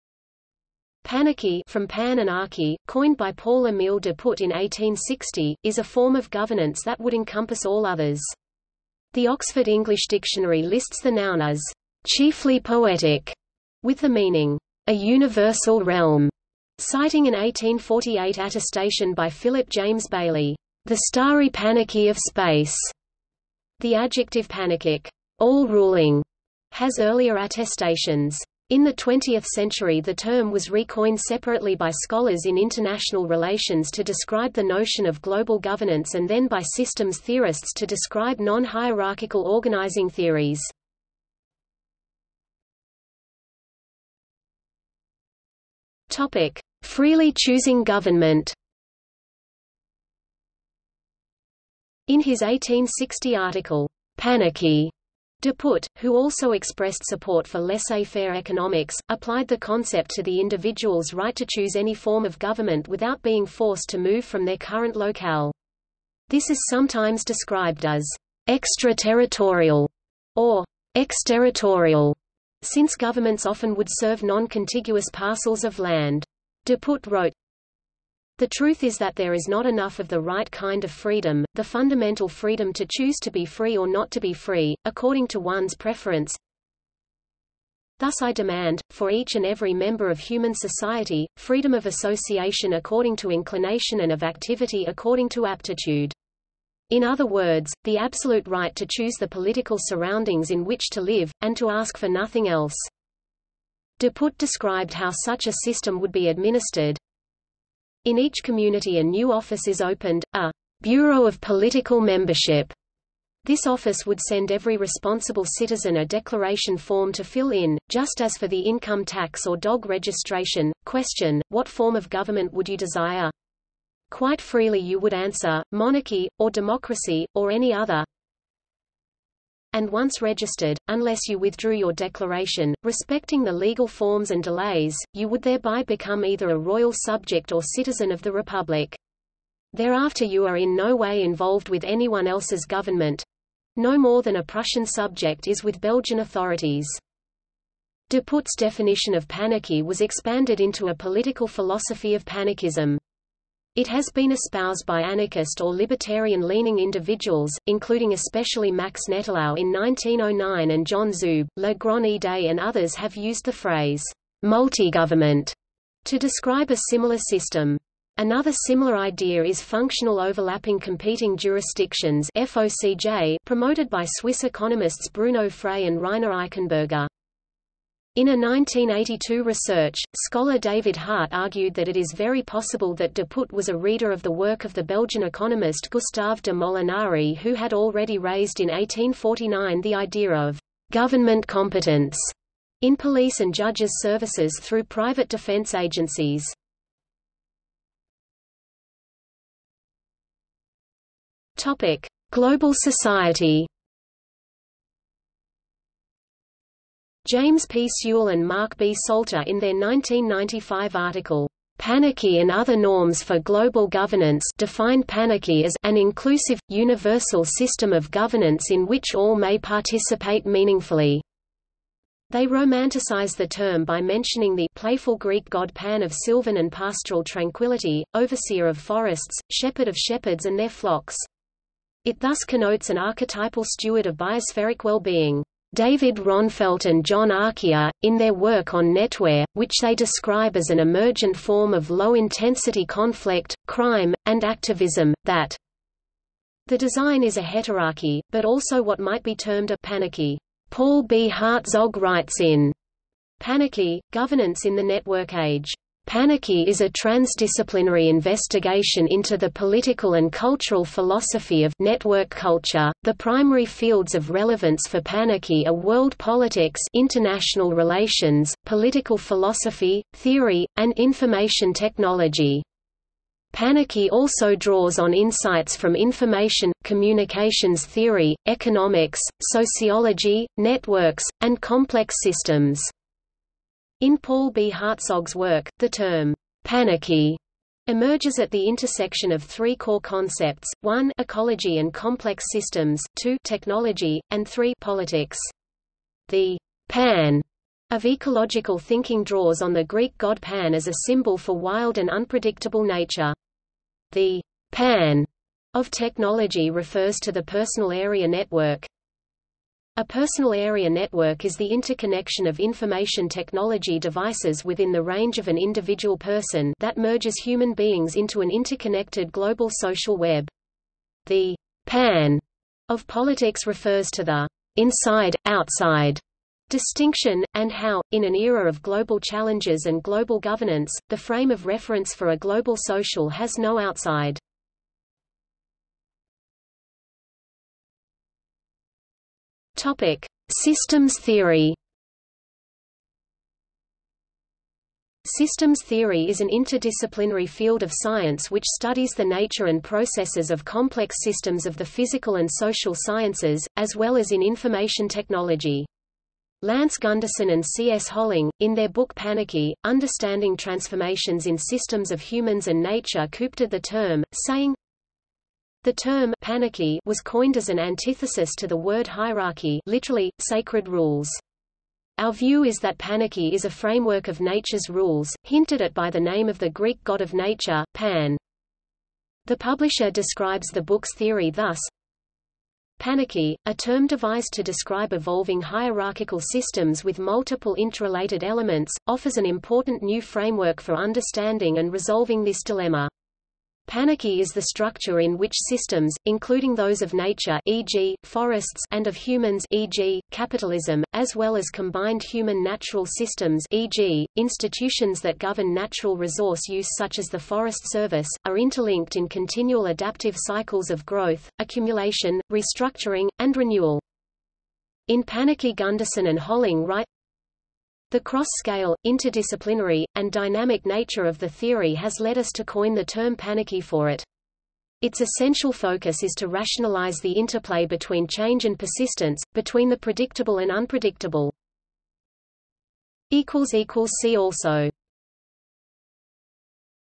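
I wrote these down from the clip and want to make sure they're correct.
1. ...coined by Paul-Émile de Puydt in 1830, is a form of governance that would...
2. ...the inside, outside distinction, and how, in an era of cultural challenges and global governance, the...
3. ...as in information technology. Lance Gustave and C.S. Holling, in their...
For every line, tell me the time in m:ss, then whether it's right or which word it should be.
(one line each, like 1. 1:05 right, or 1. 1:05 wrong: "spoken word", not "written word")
1. 0:02 wrong: "1860", not "1830"
2. 5:24 wrong: "global", not "cultural"
3. 5:54 wrong: "Gunderson", not "Gustave".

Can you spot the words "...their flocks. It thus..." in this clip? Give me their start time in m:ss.
3:50.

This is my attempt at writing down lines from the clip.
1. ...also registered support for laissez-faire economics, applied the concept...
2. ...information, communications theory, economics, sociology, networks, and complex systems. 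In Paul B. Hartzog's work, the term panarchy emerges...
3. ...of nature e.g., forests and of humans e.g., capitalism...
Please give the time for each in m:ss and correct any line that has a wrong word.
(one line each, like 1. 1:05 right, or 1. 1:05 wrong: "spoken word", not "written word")
1. 0:56 wrong: "expressed", not "registered"
2. 4:35 right
3. 6:37 right.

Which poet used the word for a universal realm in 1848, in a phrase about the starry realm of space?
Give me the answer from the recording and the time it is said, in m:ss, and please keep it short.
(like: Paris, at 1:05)
Philip James Bailey, at 0:19.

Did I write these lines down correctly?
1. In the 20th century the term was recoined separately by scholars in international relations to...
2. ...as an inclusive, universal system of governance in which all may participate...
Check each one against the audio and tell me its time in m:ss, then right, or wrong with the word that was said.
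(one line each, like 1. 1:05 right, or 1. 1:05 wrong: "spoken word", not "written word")
1. 0:28 right
2. 3:35 right.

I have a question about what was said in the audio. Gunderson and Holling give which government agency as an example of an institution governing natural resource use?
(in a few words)
Forest Service.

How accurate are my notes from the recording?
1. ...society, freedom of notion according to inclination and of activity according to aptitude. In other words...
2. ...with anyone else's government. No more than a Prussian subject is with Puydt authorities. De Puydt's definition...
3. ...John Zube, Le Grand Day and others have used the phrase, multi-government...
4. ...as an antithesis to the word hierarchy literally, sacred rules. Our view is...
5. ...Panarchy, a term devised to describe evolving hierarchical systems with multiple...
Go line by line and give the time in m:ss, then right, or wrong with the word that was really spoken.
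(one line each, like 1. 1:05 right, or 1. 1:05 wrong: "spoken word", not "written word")
1. 1:30 wrong: "association", not "notion"
2. 2:21 wrong: "Belgian", not "Puydt"
3. 2:40 right
4. 6:07 right
5. 6:22 right.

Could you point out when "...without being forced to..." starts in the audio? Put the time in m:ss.
1:02.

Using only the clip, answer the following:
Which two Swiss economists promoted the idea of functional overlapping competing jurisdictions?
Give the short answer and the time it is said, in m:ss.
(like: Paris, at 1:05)
Bruno Frey and Rainer Eichenberger, at 2:55.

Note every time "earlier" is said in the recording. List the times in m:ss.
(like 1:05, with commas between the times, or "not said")
0:26.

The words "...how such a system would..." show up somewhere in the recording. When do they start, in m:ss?
1:44.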